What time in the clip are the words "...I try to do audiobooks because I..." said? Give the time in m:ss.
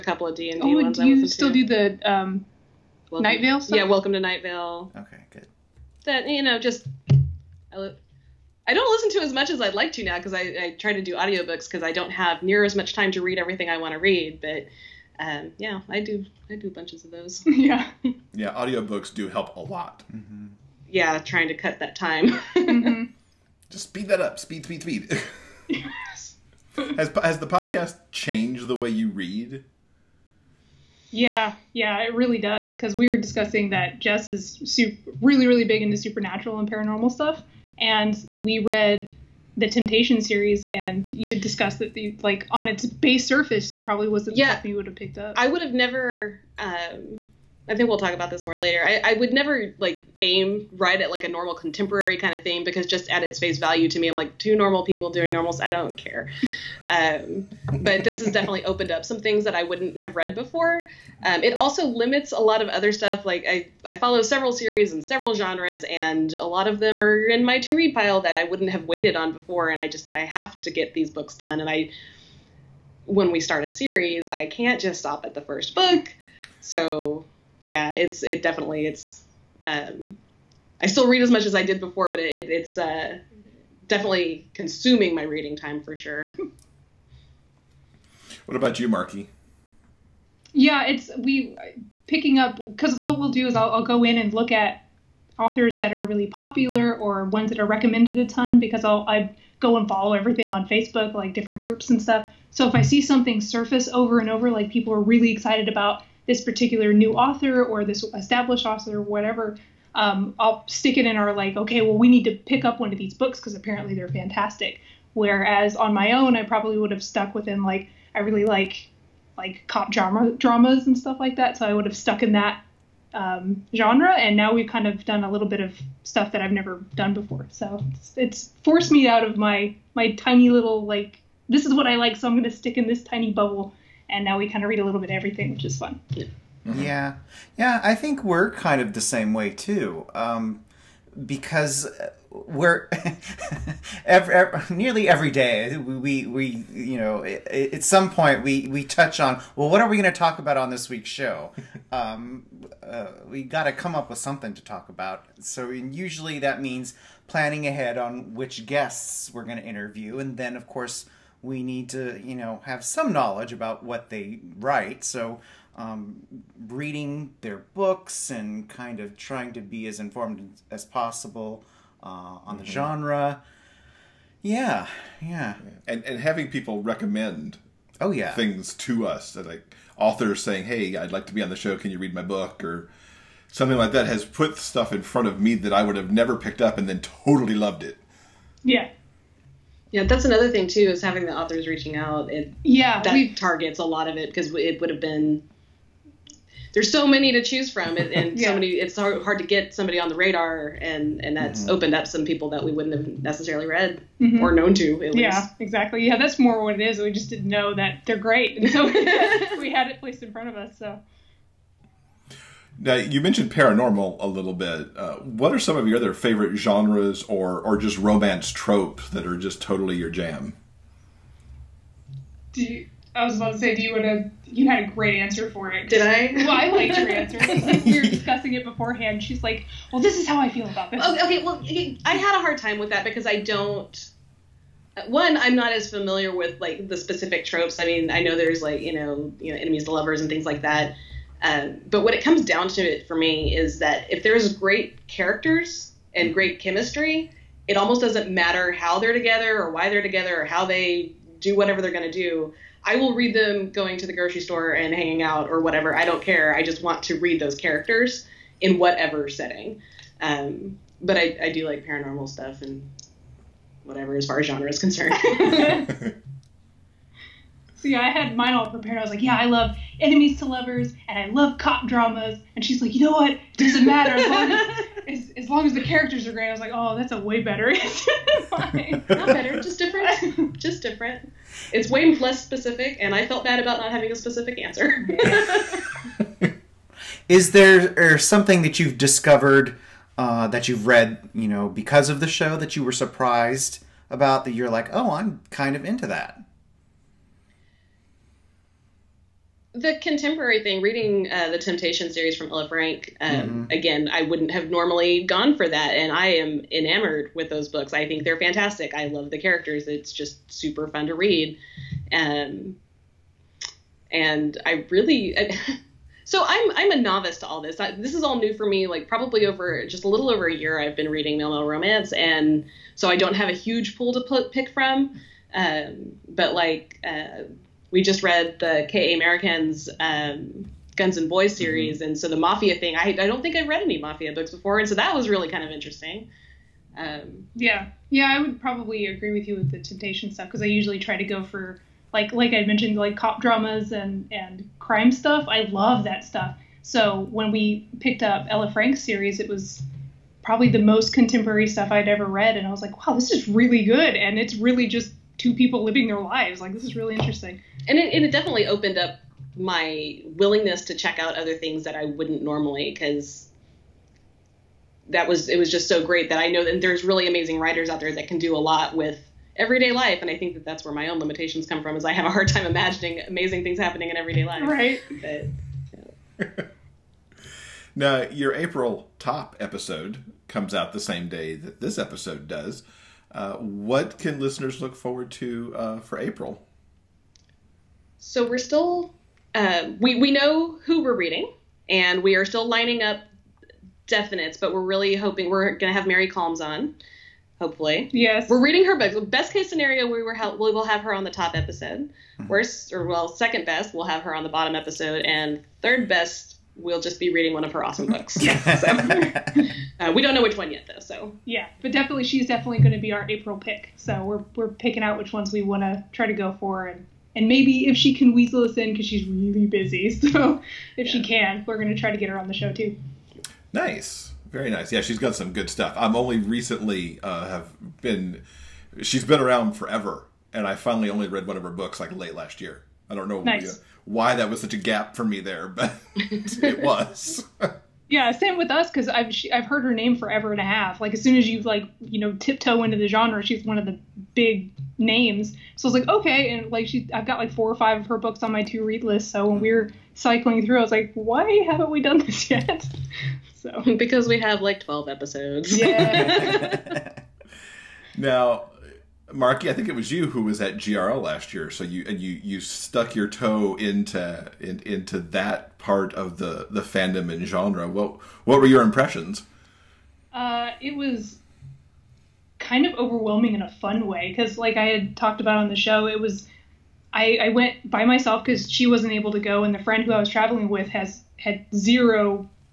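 0:10.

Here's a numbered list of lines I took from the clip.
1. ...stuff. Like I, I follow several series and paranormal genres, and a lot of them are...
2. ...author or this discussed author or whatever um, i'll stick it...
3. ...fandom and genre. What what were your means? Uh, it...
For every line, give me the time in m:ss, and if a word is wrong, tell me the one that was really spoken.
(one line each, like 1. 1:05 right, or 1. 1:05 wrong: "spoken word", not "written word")
1. 1:02 wrong: "several", not "paranormal"
2. 1:47 wrong: "established", not "discussed"
3. 7:46 wrong: "impressions", not "means".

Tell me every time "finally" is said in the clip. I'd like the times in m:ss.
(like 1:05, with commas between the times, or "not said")
7:10.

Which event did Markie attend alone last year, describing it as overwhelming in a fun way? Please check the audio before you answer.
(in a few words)
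GRL.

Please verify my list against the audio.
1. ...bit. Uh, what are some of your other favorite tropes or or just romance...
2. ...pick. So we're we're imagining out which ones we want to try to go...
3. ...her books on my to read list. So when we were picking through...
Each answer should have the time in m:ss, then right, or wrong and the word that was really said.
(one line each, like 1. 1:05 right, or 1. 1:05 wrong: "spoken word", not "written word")
1. 3:34 wrong: "genres", not "tropes"
2. 6:53 wrong: "picking", not "imagining"
3. 7:28 wrong: "cycling", not "picking".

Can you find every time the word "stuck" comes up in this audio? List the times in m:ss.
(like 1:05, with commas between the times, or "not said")
1:57, 2:01, 7:42.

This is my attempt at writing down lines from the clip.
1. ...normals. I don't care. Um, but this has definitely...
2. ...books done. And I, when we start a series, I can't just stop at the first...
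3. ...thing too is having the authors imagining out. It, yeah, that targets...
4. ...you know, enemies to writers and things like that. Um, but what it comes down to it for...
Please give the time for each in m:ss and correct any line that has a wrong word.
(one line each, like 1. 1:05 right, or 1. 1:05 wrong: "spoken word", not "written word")
1. 0:55 right
2. 1:11 right
3. 3:10 wrong: "reaching", not "imagining"
4. 3:59 wrong: "lovers", not "writers".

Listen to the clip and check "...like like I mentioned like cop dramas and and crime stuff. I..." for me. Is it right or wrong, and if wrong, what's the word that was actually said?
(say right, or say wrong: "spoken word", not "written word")
right.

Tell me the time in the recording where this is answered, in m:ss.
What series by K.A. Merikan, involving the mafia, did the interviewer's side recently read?
5:30.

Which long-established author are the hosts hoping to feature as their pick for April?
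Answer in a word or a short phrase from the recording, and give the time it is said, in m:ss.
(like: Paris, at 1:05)
Mary Calmes, at 6:36.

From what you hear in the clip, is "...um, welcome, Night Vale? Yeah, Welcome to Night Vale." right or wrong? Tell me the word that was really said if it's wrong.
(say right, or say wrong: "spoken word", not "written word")
right.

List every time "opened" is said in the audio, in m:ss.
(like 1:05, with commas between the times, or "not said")
0:58, 3:21, 5:58.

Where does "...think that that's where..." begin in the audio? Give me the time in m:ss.
6:10.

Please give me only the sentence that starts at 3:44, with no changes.
You had a great answer for it.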